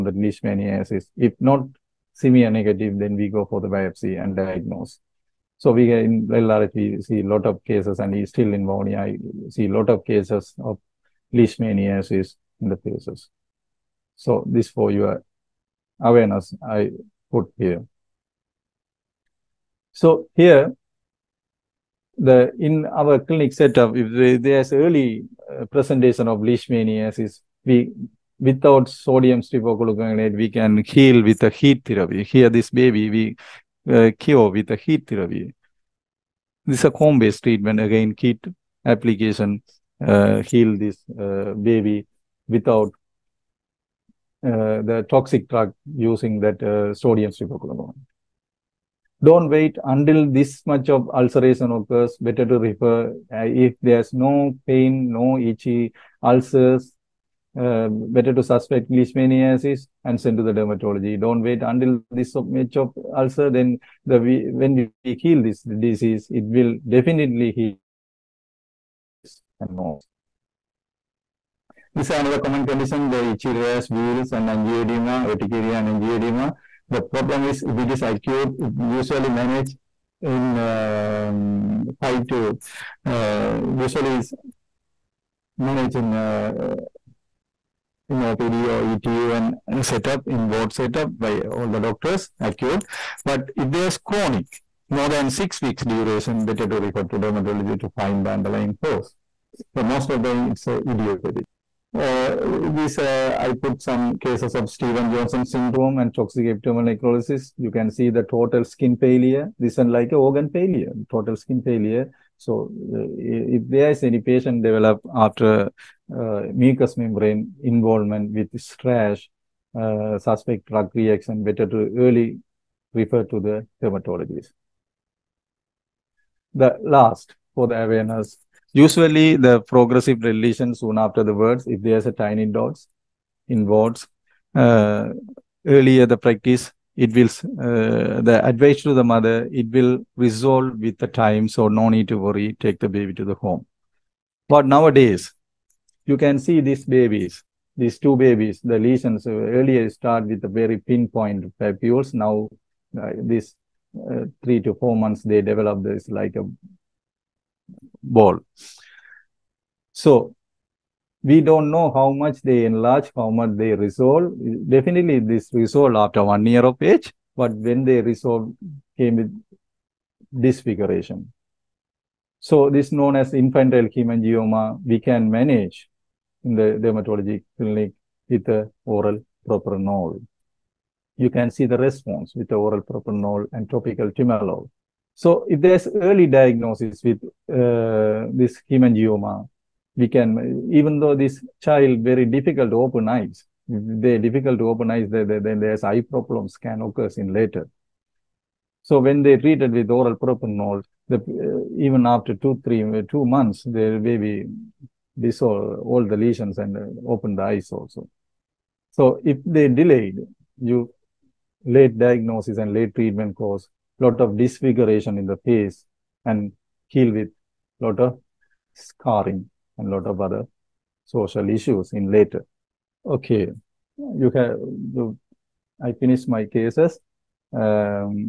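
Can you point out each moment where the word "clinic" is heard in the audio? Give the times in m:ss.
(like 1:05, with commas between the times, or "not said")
0:23, 2:57.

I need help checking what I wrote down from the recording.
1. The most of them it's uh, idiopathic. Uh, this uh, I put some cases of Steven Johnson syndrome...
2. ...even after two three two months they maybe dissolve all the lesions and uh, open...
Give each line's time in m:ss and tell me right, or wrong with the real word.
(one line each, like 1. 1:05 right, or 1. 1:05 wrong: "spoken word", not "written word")
1. 1:39 right
2. 3:21 right.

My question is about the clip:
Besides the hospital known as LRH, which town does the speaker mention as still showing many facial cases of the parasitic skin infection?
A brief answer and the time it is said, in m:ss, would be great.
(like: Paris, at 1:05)
Vavuniya, at 0:08.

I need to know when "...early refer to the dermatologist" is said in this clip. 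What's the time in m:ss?
2:01.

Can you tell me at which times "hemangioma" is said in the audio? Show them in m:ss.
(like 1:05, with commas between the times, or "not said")
2:53, 3:08.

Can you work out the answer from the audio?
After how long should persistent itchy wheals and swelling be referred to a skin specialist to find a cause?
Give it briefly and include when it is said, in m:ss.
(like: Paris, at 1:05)
6 weeks, at 1:35.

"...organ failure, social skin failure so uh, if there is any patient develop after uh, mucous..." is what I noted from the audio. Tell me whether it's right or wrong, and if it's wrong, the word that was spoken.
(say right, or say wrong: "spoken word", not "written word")
wrong: "total", not "social".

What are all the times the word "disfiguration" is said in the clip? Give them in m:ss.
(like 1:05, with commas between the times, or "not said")
2:50, 3:34.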